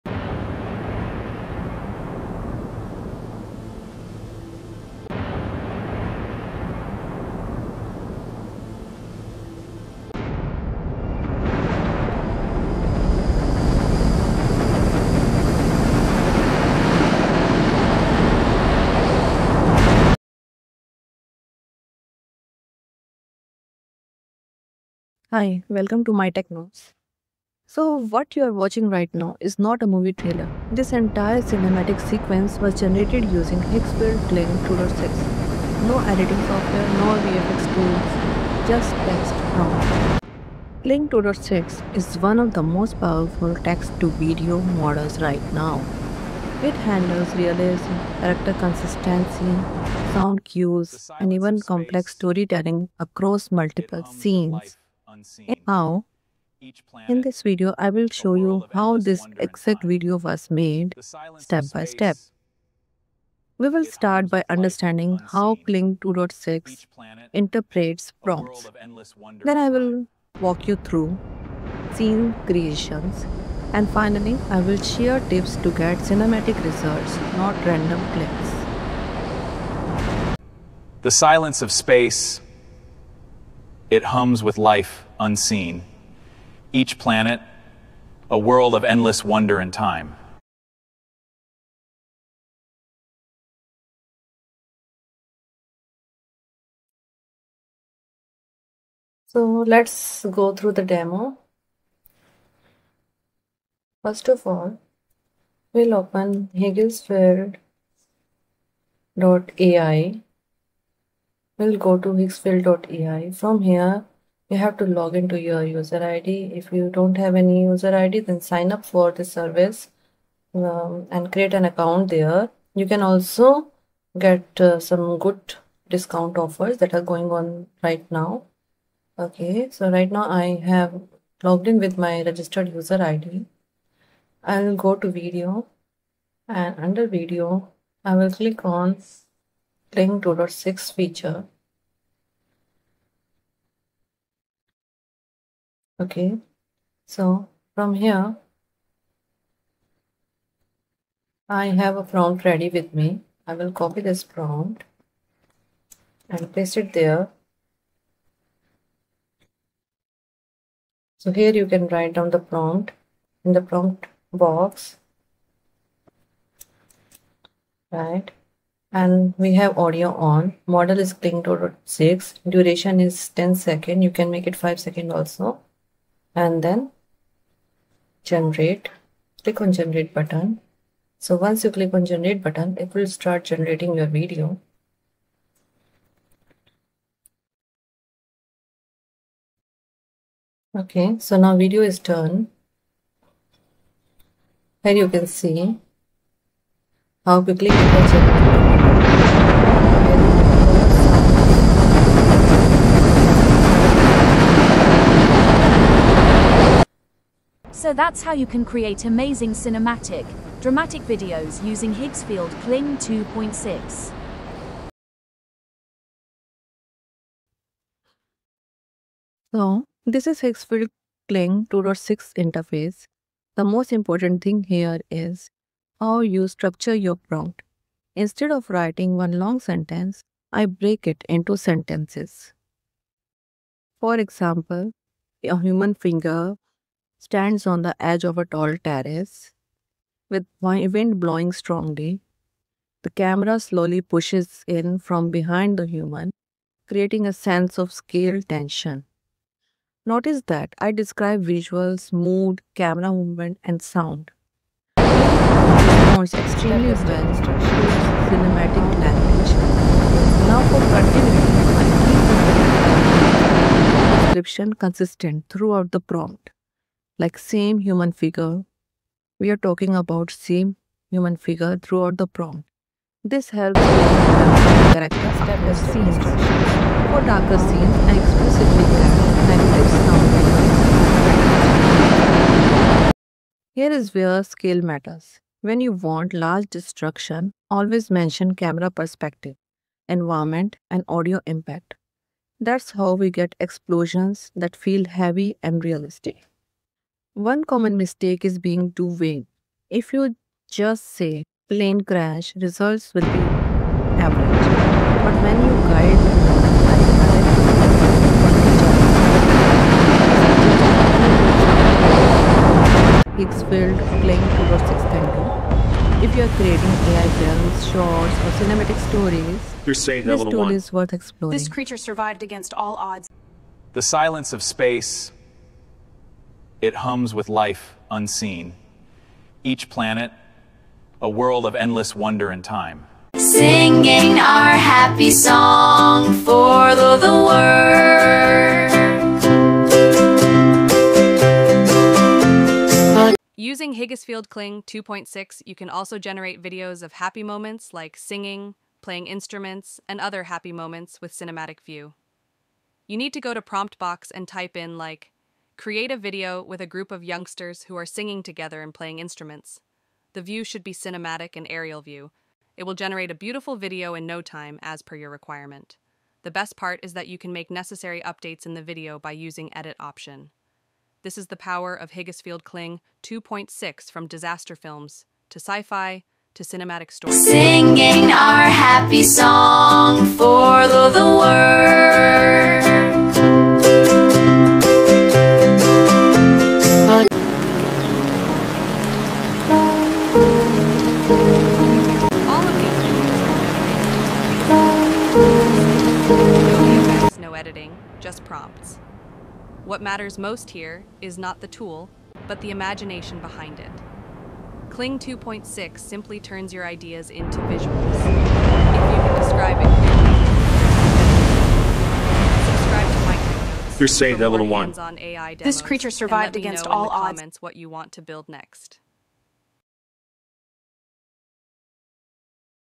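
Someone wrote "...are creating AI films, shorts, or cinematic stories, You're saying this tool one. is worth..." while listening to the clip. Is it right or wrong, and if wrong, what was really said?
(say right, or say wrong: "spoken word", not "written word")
right.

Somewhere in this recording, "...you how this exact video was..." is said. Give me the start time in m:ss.
0:58.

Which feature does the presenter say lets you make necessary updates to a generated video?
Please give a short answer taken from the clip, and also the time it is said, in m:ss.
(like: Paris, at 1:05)
Edit option, at 6:09.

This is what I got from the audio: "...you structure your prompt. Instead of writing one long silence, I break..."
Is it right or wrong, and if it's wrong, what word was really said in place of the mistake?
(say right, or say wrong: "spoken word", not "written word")
wrong: "sentence", not "silence".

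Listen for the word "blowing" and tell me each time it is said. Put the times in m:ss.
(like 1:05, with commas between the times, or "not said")
4:01.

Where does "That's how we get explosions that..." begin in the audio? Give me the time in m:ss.
4:52.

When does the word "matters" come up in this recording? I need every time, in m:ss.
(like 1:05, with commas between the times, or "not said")
4:44, 6:40.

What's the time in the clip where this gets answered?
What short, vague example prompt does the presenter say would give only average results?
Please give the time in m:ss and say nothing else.
5:01.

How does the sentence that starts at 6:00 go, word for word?
The view should be cinematic and aerial view.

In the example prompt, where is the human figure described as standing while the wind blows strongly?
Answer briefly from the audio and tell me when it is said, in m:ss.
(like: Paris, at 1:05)
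edge of a tall terrace, at 3:57.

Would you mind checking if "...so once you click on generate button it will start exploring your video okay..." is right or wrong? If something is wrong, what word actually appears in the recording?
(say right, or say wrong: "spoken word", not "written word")
wrong: "generating", not "exploring".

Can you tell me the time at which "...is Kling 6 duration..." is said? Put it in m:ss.
2:50.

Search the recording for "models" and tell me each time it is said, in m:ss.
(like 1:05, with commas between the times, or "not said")
0:44, 2:50.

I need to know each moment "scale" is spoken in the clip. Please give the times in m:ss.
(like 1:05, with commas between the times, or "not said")
4:07, 4:44.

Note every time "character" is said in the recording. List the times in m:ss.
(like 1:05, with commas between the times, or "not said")
0:48, 4:34.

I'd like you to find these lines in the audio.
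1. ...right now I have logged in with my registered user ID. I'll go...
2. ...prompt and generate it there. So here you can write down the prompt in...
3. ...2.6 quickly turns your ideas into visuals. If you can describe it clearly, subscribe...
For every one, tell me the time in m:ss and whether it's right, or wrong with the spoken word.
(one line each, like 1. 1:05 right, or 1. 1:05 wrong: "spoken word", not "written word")
1. 2:09 right
2. 2:34 wrong: "paste", not "generate"
3. 6:45 wrong: "simply", not "quickly".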